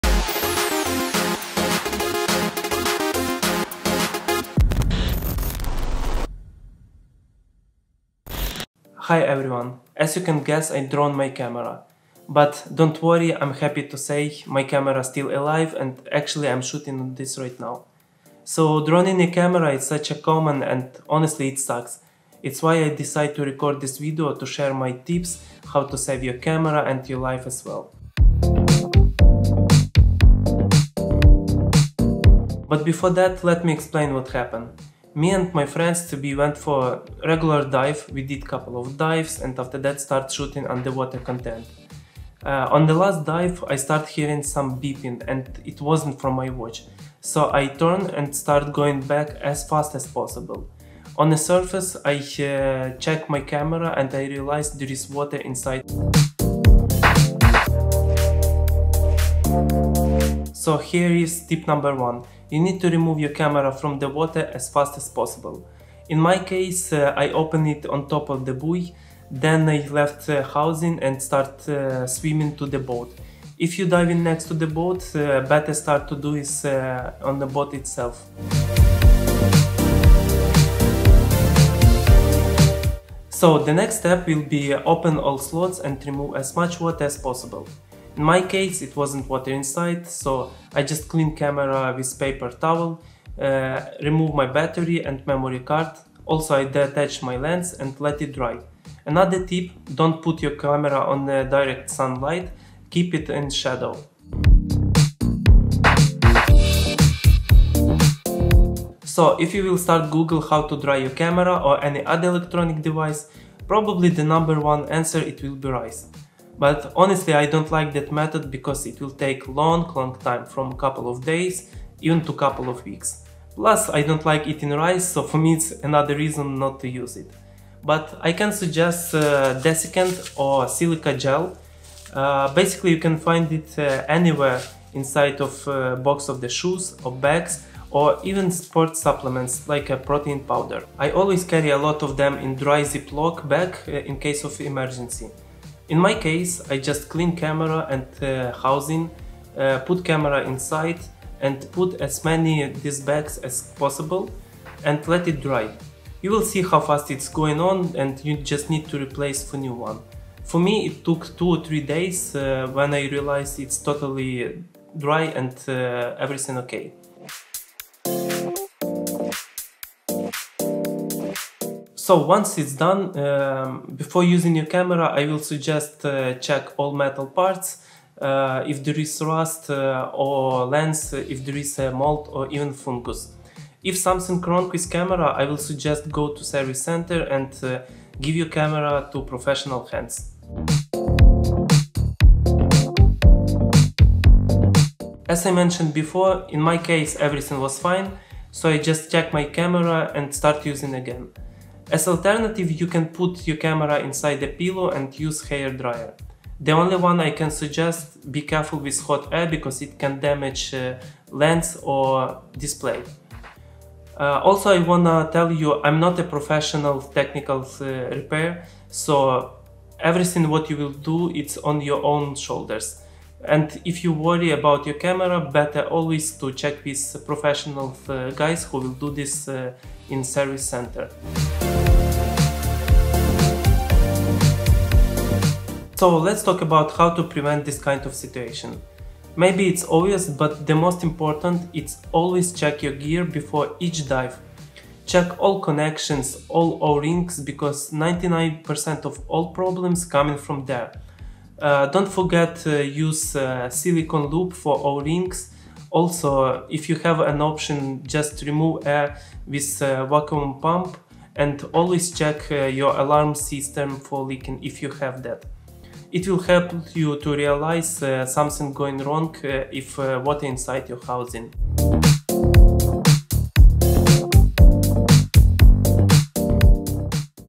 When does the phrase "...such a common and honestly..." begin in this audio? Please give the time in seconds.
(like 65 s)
19 s.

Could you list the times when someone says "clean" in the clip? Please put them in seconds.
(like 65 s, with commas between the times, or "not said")
91 s, 147 s.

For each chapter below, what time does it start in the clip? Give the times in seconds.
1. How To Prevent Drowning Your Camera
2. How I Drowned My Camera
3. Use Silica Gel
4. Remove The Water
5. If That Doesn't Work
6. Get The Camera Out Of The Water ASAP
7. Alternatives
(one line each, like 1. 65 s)
1. 233 s
2. 30 s
3. 106 s
4. 79 s
5. 169 s
6. 58 s
7. 192 s.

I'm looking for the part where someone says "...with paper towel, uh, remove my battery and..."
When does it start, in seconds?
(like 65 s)
91 s.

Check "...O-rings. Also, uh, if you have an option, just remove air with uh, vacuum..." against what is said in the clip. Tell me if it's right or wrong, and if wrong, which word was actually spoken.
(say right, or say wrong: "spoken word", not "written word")
right.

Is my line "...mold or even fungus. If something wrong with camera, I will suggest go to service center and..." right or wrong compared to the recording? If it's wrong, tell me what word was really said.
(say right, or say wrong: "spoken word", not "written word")
right.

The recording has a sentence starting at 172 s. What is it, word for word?
So once it's done, um, before using your camera, I will suggest uh, check all metal parts.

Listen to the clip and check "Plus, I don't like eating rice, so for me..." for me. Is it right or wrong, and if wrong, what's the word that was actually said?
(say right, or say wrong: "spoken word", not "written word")
right.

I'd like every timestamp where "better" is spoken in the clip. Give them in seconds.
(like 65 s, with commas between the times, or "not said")
75 s, 225 s.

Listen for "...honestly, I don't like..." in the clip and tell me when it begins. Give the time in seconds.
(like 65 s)
116 s.